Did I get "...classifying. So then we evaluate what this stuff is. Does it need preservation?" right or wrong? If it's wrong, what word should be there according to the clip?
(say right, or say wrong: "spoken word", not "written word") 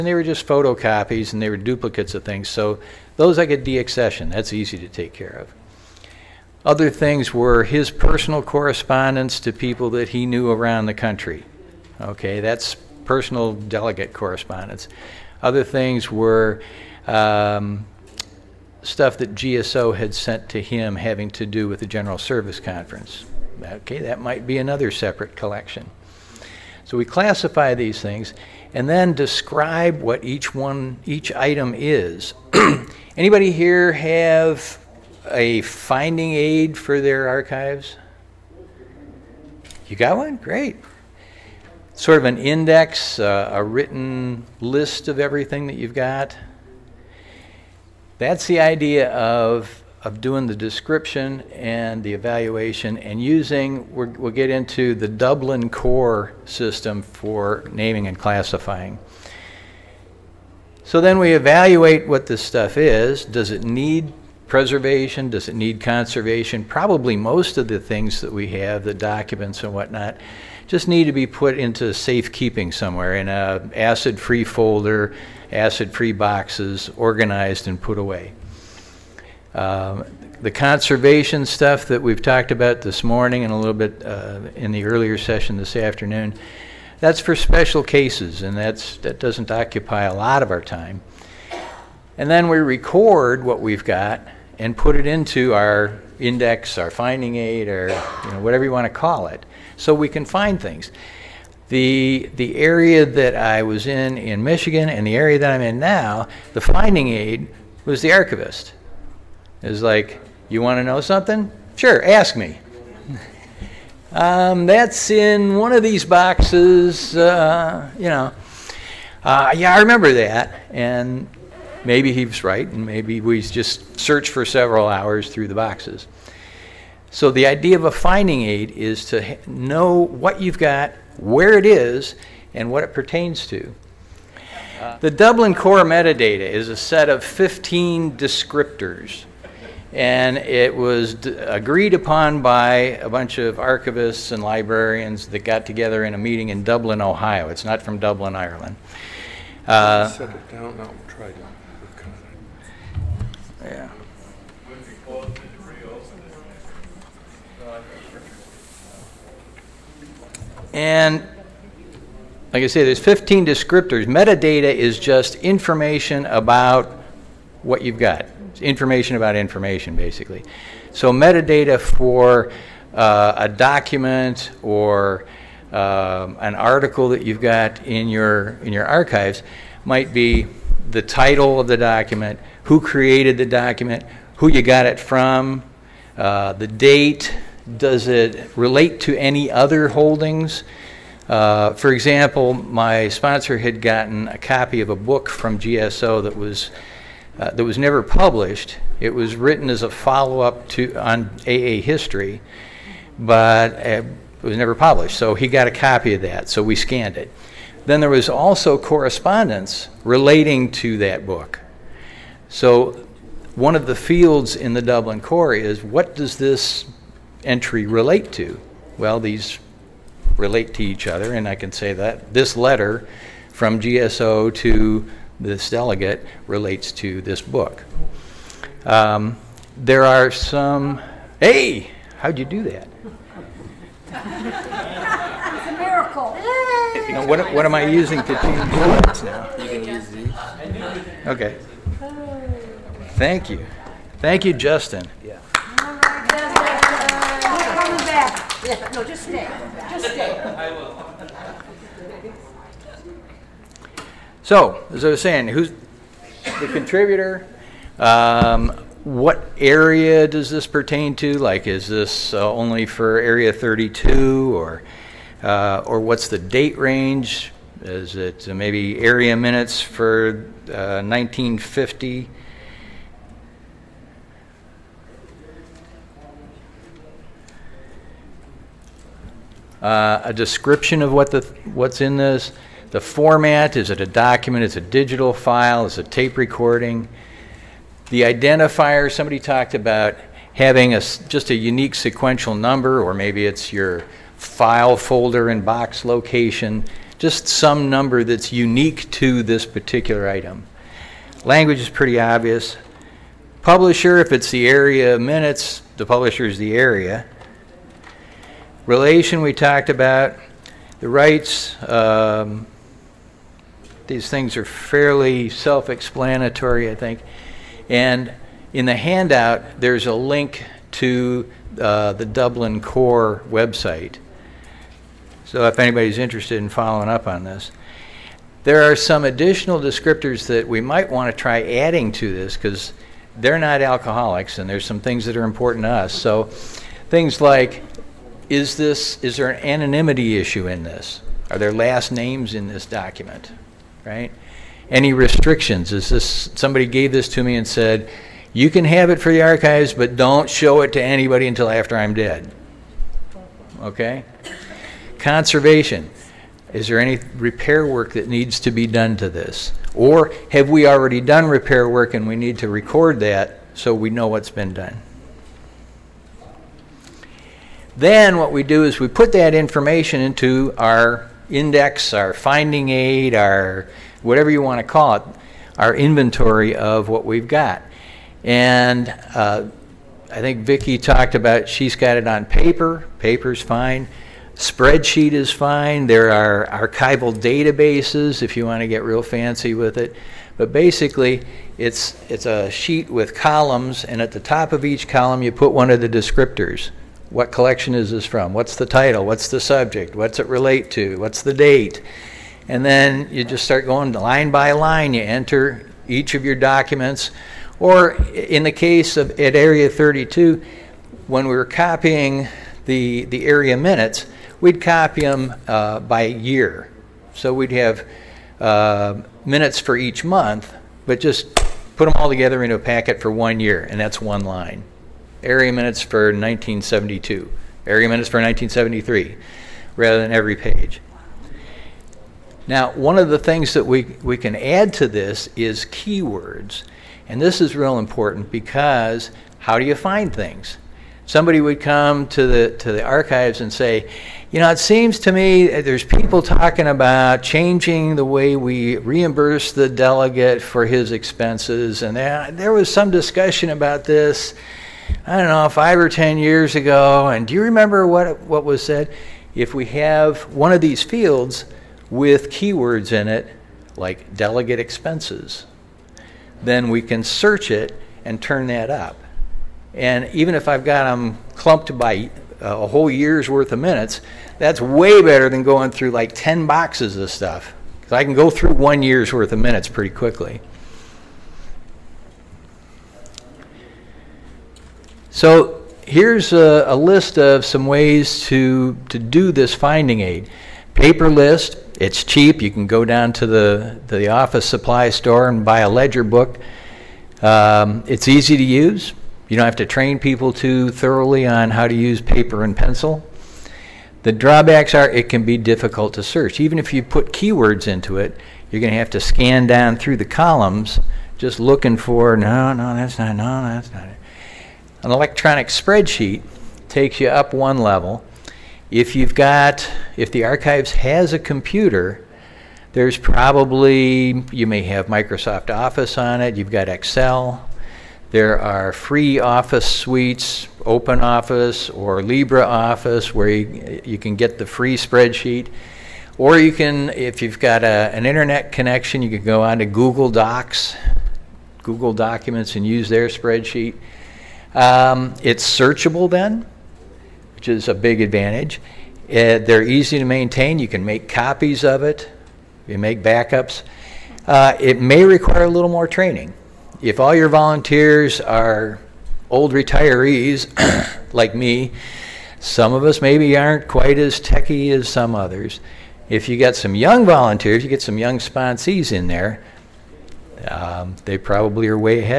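right.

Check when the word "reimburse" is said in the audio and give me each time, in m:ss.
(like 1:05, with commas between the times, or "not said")
7:28.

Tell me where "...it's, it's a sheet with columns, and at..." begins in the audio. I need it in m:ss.
6:31.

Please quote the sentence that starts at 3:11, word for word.
Uh, for example, my sponsor had gotten a copy of a book from GSO that was uh, that was never published.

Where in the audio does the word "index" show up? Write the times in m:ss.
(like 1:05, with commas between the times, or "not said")
0:42, 1:36, 6:11.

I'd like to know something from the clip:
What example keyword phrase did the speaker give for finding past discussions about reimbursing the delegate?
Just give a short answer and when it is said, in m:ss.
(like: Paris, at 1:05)
delegate expenses, at 7:44.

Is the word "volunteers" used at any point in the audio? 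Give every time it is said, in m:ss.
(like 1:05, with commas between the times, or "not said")
9:17, 9:27.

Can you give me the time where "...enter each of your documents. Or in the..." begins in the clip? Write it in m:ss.
6:45.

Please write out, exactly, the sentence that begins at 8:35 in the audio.
An electronic spreadsheet takes you up one level.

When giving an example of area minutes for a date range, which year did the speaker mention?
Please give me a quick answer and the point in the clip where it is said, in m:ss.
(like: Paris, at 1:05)
1950, at 4:31.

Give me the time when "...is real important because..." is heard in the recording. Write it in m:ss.
7:17.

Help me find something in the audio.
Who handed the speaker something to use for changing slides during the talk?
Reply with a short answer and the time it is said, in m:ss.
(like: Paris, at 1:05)
Justin, at 4:04.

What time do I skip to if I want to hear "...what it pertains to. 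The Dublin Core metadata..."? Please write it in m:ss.
2:12.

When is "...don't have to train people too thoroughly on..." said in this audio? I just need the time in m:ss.
8:19.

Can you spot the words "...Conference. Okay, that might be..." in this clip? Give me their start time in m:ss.
0:22.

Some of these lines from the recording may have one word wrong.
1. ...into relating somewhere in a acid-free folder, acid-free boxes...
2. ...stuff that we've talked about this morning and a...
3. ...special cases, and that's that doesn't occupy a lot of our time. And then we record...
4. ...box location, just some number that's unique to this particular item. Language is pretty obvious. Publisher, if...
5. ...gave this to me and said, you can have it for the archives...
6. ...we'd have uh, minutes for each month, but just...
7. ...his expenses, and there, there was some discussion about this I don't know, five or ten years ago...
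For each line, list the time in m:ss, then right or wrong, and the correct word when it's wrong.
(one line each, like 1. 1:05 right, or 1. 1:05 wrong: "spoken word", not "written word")
1. 1:11 wrong: "safekeeping", not "relating"
2. 1:21 right
3. 1:27 right
4. 4:55 right
5. 5:46 right
6. 6:57 right
7. 7:30 right.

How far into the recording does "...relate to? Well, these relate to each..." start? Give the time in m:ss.
3:37.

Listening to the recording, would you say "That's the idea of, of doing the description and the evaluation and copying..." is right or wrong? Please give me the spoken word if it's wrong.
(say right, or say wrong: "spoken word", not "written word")
wrong: "using", not "copying".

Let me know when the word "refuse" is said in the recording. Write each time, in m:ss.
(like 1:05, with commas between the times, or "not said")
not said.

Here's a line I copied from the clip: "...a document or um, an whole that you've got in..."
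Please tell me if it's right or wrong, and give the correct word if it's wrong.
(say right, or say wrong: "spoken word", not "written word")
wrong: "article", not "whole".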